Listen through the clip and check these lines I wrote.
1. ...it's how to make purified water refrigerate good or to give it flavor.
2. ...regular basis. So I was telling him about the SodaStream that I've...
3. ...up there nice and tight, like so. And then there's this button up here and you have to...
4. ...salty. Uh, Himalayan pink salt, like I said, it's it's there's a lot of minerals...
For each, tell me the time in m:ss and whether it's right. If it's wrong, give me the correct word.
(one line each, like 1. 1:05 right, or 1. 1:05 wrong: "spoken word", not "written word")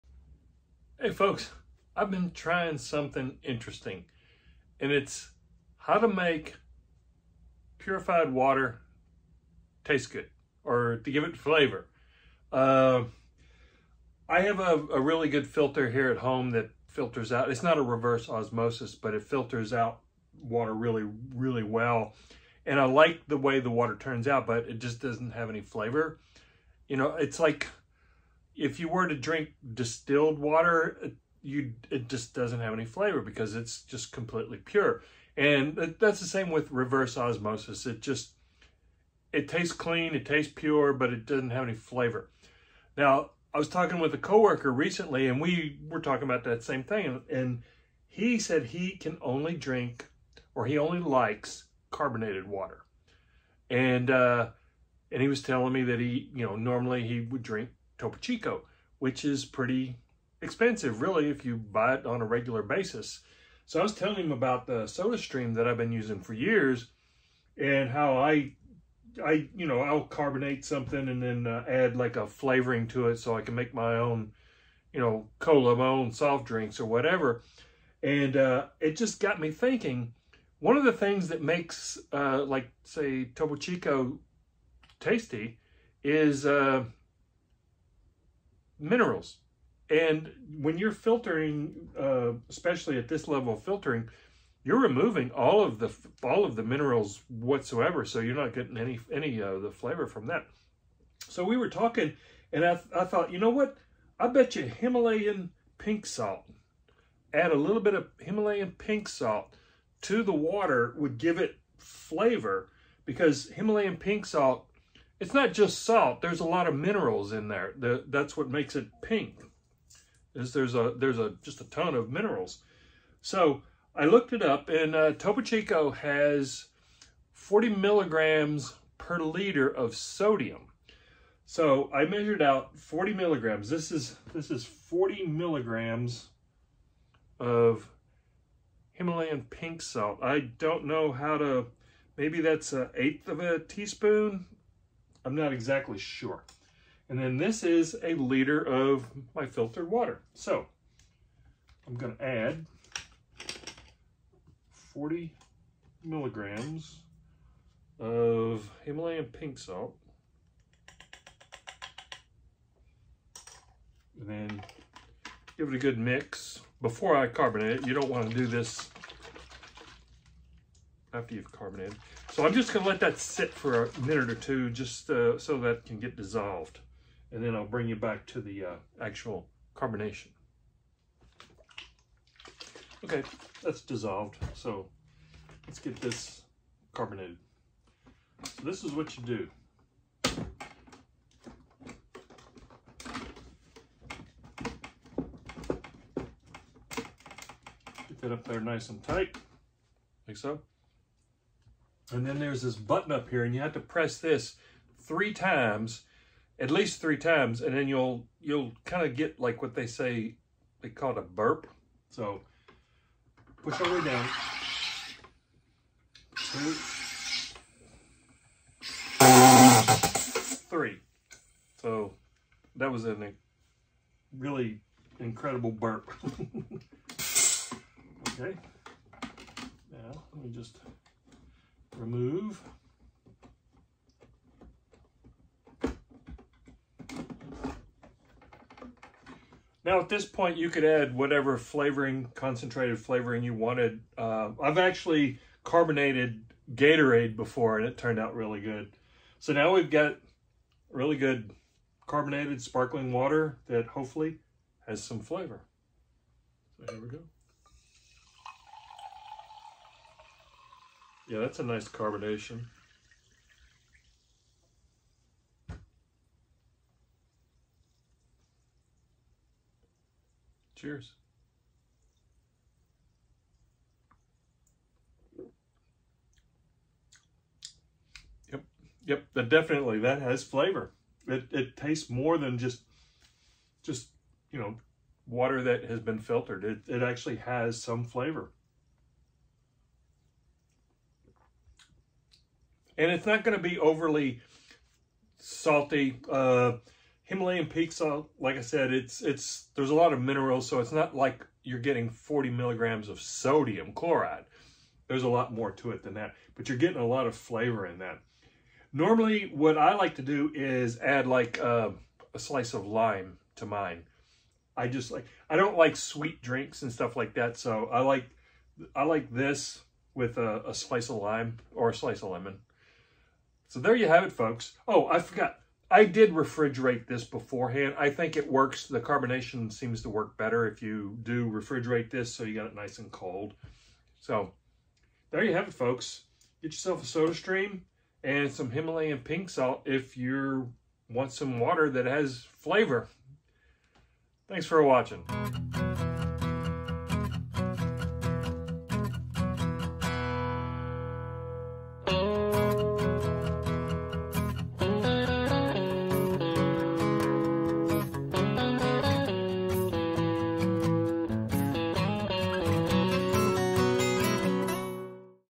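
1. 0:04 wrong: "taste", not "refrigerate"
2. 1:02 right
3. 3:18 right
4. 4:55 right.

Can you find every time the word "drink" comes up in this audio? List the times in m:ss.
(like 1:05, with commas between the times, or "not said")
0:29, 0:49, 0:57, 1:16, 5:16.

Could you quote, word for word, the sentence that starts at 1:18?
And uh, it just got me thinking, one of the things that makes, uh, like, say, Topo Chico tasty is uh, minerals.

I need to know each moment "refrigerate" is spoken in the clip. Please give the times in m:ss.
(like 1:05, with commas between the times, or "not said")
5:26, 5:31.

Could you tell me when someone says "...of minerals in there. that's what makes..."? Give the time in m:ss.
1:56.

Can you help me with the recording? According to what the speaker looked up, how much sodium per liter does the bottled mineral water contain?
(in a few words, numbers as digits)
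40 milligrams.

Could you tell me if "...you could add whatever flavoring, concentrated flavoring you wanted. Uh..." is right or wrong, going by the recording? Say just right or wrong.
right.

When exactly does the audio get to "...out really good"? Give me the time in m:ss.
4:08.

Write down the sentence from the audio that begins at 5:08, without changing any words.
Normally, what I like to do is add like uh, a slice of lime to mine.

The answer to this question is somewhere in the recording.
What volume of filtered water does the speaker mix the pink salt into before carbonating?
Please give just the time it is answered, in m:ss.
2:28.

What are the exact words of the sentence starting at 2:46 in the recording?
Before I carbonate it, you don't want to do this after you've carbonated.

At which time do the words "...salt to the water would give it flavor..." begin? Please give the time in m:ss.
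1:49.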